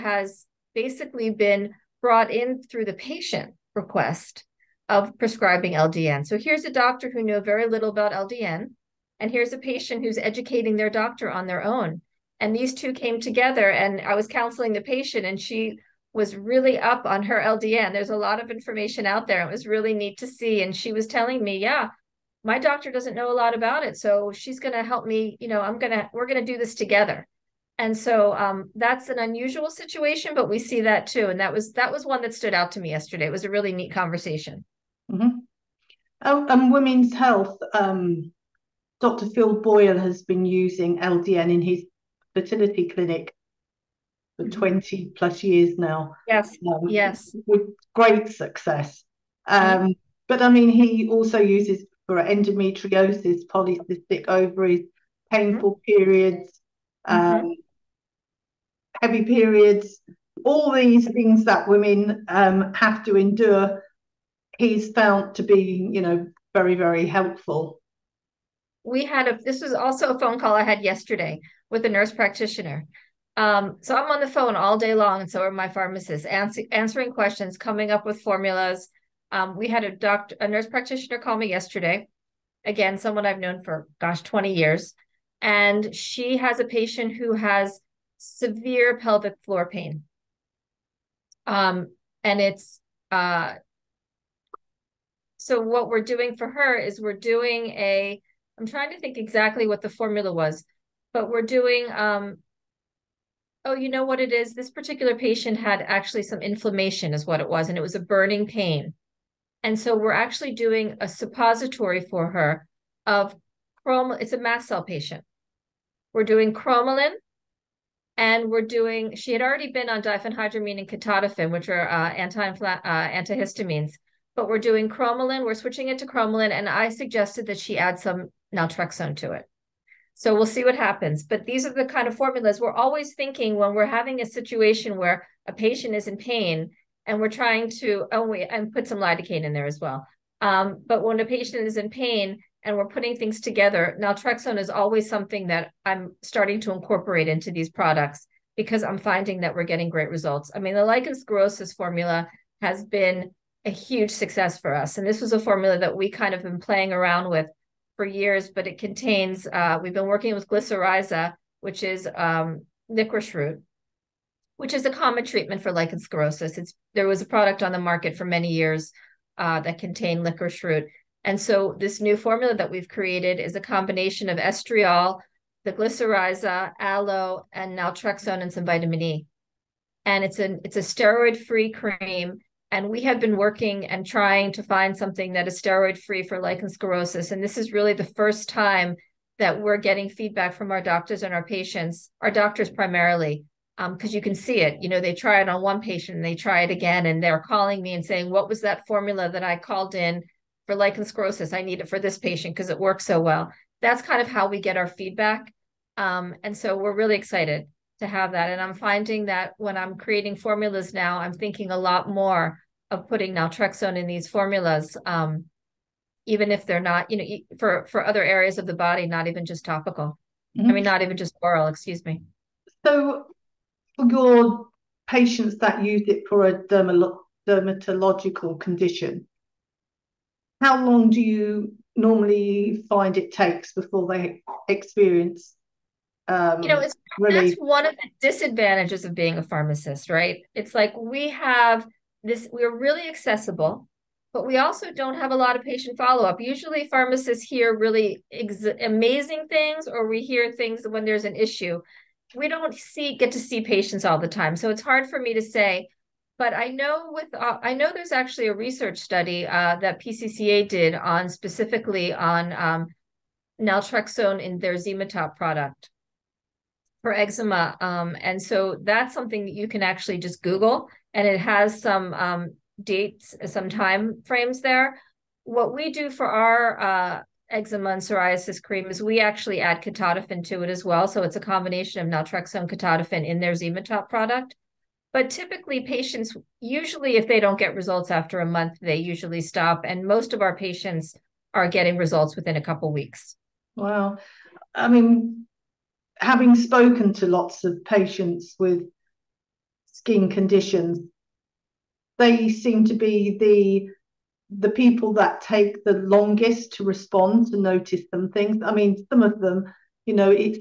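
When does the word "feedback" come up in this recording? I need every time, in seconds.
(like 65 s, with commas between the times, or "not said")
190 s, 204 s.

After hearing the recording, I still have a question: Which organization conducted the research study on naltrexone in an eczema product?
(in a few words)
PCCA.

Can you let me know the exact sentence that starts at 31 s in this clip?
And that was, that was one that stood out to me yesterday.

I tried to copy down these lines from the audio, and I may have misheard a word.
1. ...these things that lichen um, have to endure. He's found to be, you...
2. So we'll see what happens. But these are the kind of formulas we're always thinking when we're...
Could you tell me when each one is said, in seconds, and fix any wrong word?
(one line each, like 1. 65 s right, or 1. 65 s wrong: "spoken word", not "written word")
1. 60 s wrong: "women", not "lichen"
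2. 130 s right.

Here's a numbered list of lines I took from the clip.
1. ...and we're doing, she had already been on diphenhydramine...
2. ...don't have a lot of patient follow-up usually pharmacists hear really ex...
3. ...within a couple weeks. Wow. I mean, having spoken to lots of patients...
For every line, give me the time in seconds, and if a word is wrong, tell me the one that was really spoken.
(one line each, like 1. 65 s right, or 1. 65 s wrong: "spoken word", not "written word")
1. 118 s right
2. 244 s right
3. 292 s right.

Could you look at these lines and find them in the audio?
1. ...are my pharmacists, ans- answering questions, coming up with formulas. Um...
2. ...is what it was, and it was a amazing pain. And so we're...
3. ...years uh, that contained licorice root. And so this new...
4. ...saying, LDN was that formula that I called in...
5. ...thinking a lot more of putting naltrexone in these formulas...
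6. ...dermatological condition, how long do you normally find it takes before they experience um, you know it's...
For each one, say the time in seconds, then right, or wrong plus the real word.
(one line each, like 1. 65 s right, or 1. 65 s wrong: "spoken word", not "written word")
1. 75 s right
2. 107 s wrong: "burning", not "amazing"
3. 168 s right
4. 198 s wrong: "What", not "LDN"
5. 211 s right
6. 226 s right.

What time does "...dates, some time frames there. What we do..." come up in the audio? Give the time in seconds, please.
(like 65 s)
272 s.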